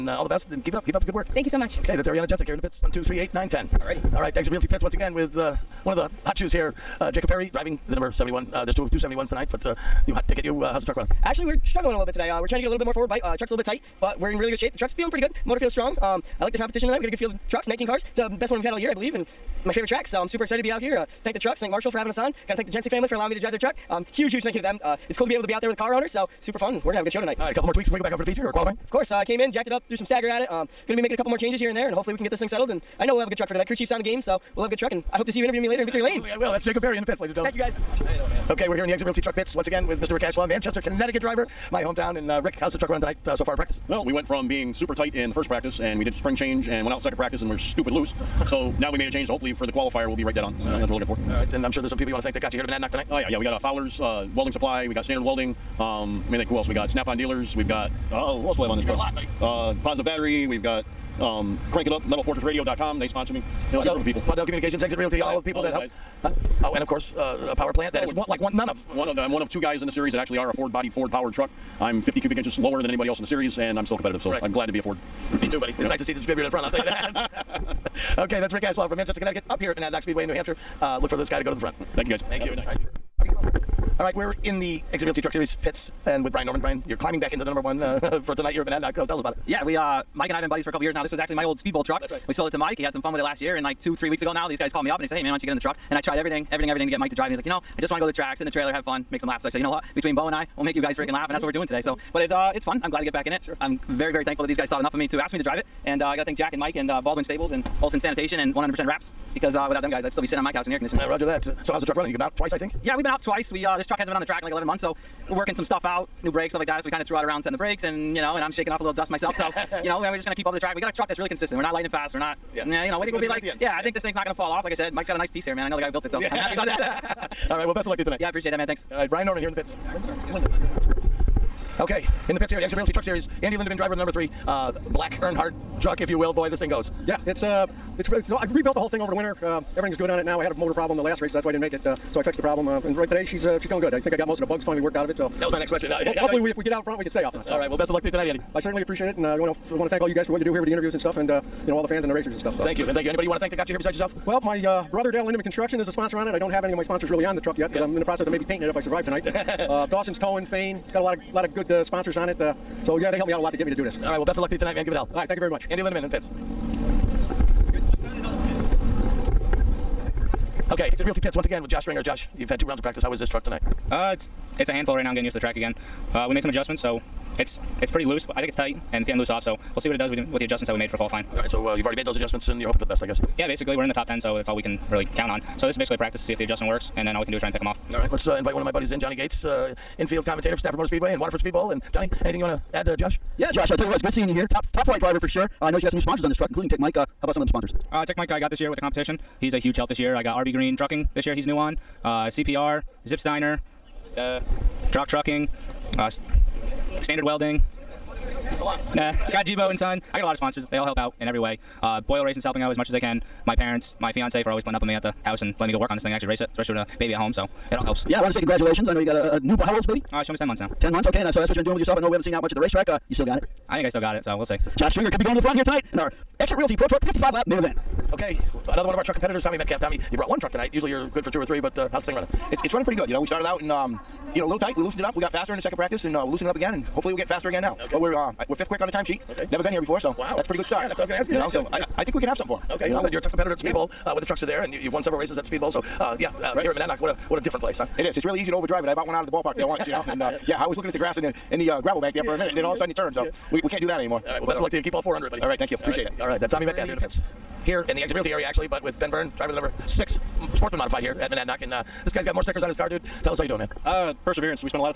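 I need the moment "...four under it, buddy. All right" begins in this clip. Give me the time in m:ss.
4:15.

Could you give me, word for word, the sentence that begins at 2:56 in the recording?
Uh, we made some adjustments, so it's it's pretty loose.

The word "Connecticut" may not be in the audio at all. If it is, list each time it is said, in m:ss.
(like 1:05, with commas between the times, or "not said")
0:40, 1:19.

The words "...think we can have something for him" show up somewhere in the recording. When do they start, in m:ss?
4:02.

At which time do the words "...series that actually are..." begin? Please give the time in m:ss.
1:09.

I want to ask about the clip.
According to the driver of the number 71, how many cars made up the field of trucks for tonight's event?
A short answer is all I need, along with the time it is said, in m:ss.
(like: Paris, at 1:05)
19, at 0:17.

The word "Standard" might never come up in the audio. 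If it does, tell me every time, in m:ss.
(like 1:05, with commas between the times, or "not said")
0:55, 3:26.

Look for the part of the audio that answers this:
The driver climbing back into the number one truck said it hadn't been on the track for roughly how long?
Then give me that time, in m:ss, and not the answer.
1:54.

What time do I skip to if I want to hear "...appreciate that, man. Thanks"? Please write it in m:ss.
2:08.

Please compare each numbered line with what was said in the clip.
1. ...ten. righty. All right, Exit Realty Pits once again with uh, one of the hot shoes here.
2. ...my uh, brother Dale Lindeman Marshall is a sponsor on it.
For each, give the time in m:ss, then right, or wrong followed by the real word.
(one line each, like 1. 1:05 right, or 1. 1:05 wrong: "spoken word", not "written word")
1. 0:03 right
2. 2:34 wrong: "Construction", not "Marshall".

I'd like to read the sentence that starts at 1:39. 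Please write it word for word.
Between Bo and I." we'll make you guys freaking laugh, and that's what we're doing today.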